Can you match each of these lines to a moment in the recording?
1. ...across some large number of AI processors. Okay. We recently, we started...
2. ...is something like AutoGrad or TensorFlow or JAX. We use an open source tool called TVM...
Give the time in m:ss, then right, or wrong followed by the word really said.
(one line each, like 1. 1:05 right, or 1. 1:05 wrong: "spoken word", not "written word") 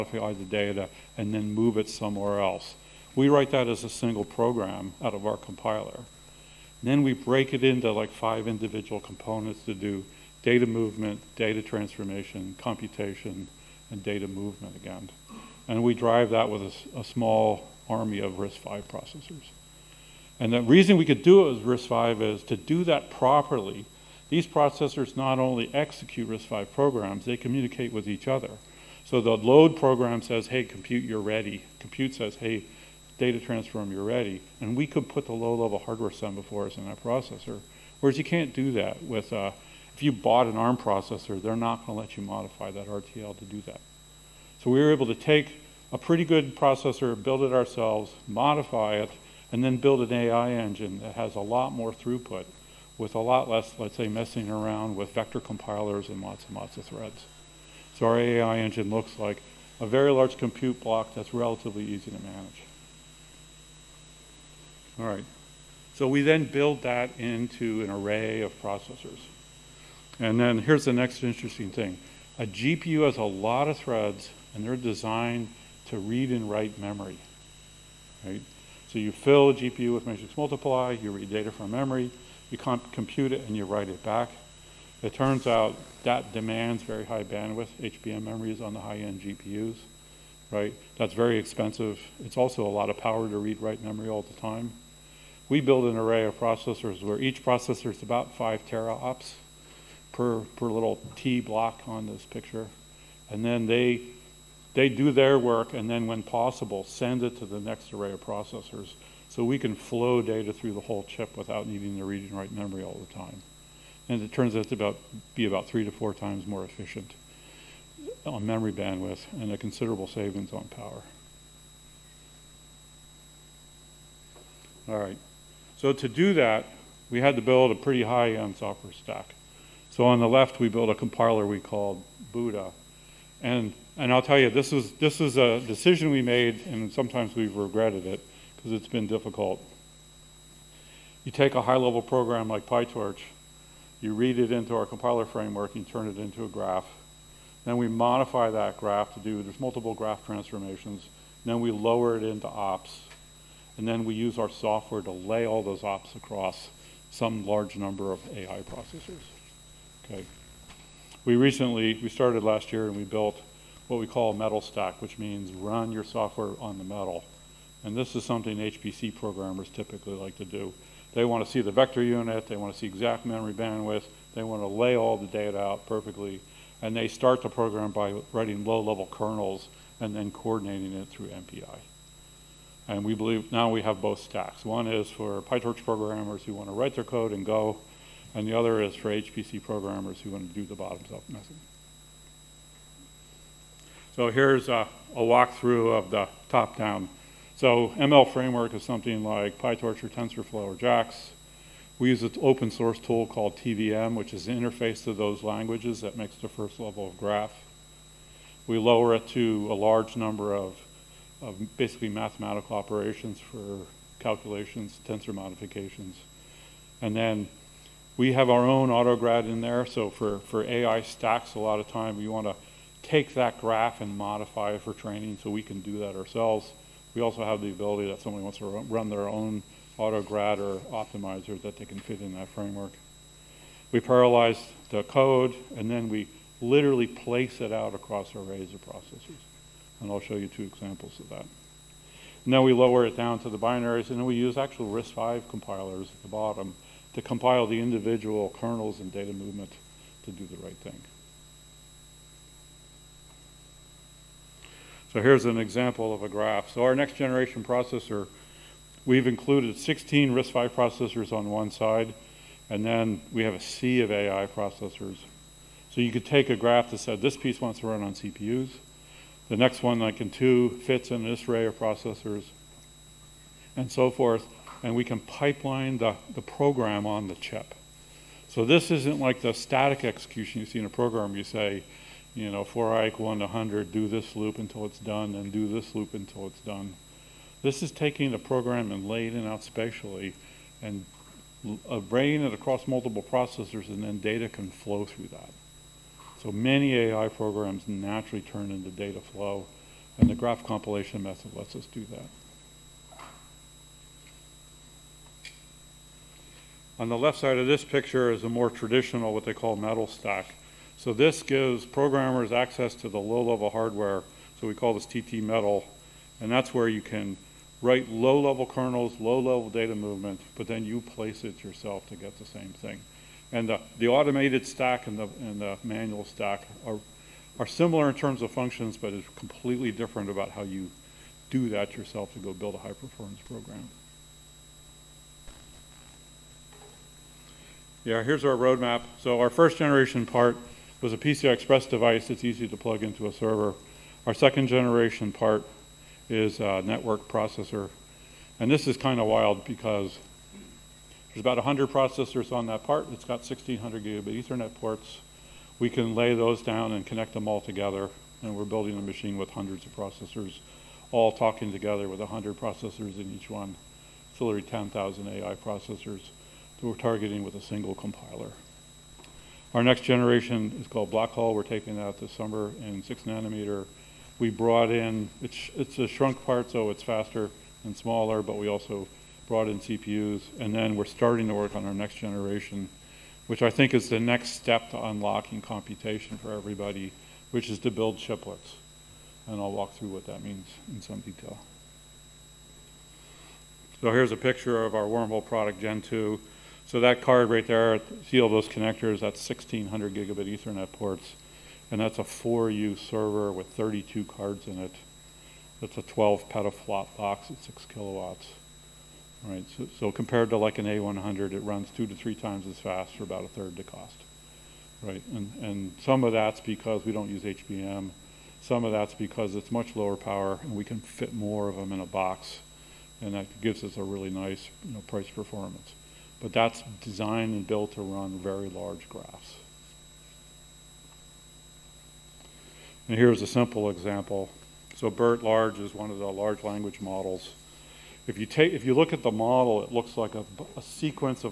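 1. 2:36 right
2. 3:18 wrong: "PyTorch", not "AutoGrad".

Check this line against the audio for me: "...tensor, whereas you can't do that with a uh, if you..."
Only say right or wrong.
wrong.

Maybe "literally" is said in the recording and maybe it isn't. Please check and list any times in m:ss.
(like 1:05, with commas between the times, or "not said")
3:56, 6:04.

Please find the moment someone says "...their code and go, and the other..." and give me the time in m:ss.
3:06.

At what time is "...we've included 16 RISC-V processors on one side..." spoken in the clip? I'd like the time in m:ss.
4:19.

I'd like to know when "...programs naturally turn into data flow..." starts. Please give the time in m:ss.
4:57.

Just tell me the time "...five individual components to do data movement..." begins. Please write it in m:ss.
0:08.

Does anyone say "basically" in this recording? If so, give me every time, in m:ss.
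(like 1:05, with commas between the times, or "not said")
3:31.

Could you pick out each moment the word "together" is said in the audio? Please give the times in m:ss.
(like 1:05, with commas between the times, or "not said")
5:57, 6:01.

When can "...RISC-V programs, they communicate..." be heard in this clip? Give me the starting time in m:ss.
0:26.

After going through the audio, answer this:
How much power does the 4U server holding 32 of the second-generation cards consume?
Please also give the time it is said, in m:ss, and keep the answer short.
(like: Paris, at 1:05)
6 kilowatts, at 6:47.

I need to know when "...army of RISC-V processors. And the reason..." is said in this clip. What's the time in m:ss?
0:17.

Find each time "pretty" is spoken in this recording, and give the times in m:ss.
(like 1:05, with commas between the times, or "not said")
0:45, 2:07.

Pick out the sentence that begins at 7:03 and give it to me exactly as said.
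And that gives us a really nice you know, price performance.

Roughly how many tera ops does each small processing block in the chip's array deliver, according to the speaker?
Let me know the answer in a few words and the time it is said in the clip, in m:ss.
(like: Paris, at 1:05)
5, at 1:38.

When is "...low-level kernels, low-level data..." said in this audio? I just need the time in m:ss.
5:18.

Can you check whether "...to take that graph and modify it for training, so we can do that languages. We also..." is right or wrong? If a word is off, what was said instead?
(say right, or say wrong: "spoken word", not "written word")
wrong: "ourselves", not "languages".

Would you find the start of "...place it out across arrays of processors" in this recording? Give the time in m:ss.
3:57.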